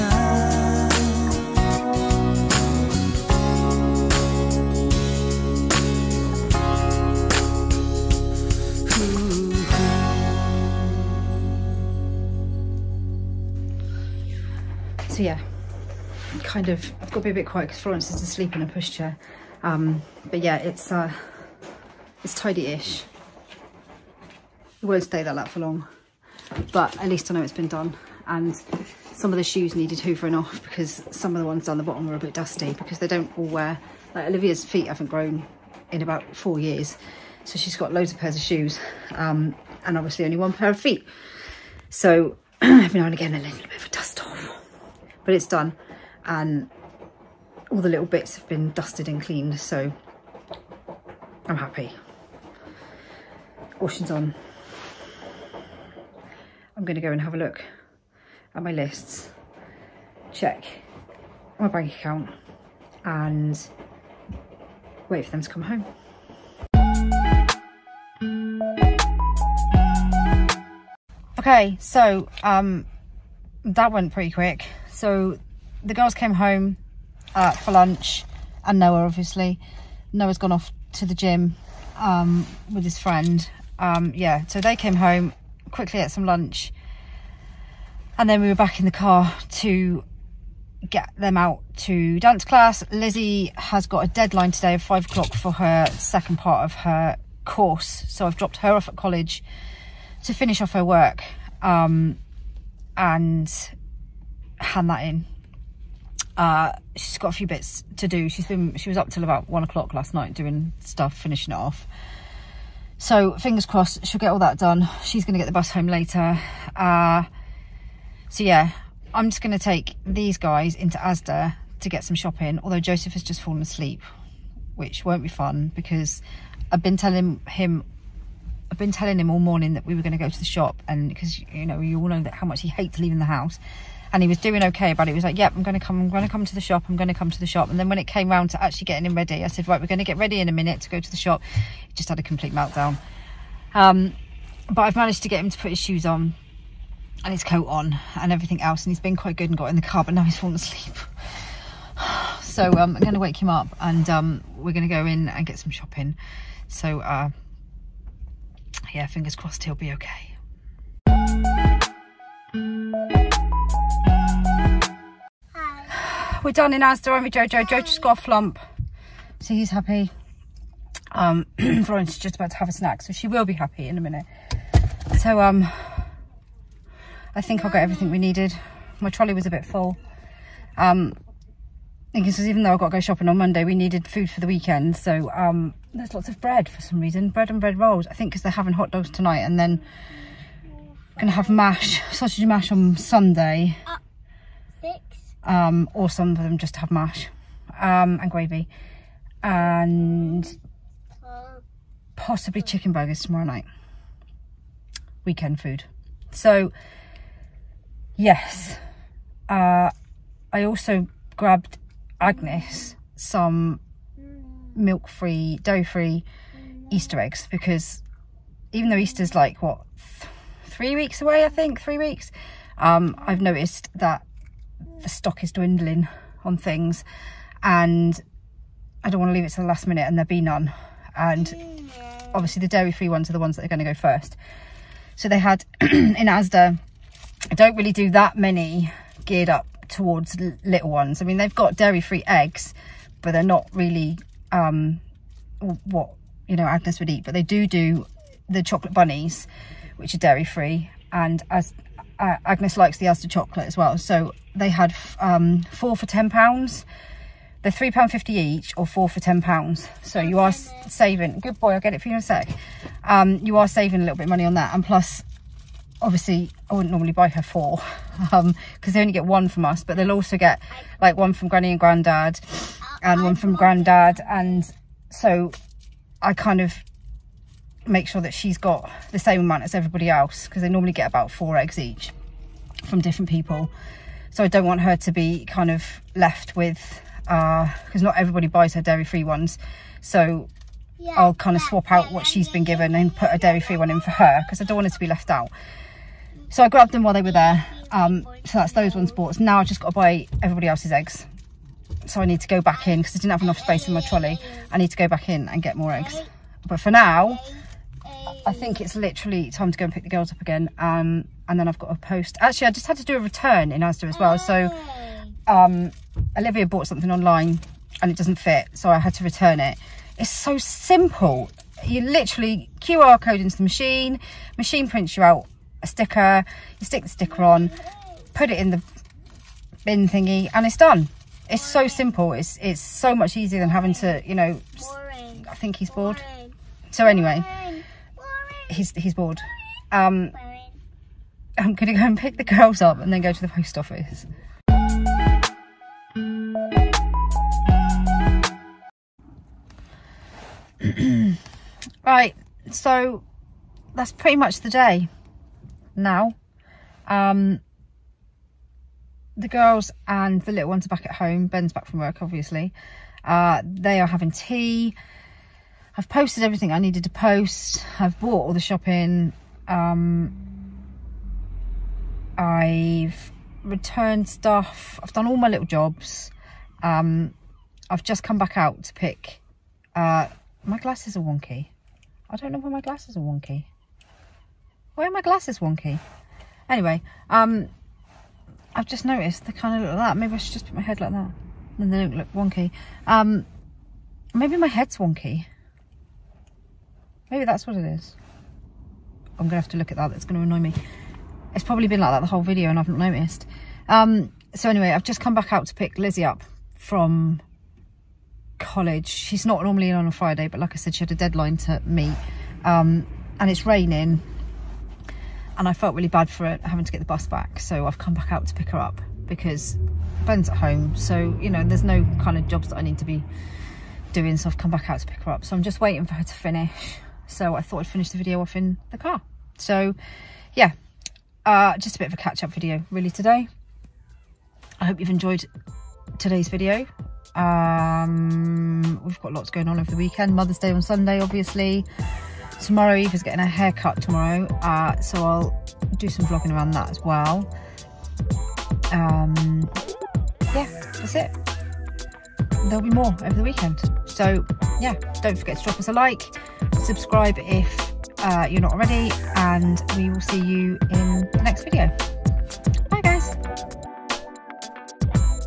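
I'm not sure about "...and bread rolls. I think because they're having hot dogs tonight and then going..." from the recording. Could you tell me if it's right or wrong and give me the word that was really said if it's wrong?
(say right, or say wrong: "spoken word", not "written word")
right.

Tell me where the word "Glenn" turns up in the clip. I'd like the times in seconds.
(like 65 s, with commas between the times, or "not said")
not said.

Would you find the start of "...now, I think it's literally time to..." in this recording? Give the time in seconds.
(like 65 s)
306 s.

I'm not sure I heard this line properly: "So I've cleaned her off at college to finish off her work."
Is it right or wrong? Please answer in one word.
wrong.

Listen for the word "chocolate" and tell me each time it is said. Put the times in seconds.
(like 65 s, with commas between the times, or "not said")
248 s, 253 s.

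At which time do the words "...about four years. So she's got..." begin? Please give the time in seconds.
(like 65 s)
36 s.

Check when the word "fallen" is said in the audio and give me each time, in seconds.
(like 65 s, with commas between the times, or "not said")
123 s, 150 s.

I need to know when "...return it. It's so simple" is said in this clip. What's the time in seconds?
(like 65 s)
319 s.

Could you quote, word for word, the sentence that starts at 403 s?
Um, so anyway, I've just come back out to pick Lizzie up from college.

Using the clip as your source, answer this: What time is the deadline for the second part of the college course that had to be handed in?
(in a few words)
5 o'clock.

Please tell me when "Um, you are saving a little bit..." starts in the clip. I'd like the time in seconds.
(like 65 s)
263 s.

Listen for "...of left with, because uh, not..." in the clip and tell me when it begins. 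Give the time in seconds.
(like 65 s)
285 s.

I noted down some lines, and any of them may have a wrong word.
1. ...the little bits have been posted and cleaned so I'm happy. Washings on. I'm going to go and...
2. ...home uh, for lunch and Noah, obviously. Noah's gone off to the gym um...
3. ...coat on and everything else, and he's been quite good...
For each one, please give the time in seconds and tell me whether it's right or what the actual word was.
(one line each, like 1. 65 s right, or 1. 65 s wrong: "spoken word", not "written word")
1. 47 s wrong: "dusted", not "posted"
2. 76 s right
3. 147 s right.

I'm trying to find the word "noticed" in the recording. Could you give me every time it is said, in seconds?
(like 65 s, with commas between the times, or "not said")
223 s, 389 s, 402 s.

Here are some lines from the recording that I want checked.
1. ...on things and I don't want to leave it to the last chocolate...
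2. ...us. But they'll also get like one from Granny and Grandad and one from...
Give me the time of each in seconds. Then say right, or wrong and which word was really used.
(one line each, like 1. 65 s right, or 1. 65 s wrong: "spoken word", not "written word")
1. 226 s wrong: "minute", not "chocolate"
2. 269 s right.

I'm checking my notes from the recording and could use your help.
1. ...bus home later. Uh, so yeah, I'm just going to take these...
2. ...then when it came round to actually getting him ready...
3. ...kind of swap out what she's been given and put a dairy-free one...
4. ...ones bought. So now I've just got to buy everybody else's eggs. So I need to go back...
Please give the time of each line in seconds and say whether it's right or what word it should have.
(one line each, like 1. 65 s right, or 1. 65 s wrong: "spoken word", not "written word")
1. 115 s right
2. 137 s right
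3. 291 s right
4. 298 s right.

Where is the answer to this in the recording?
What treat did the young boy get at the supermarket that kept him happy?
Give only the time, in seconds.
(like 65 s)
168 s.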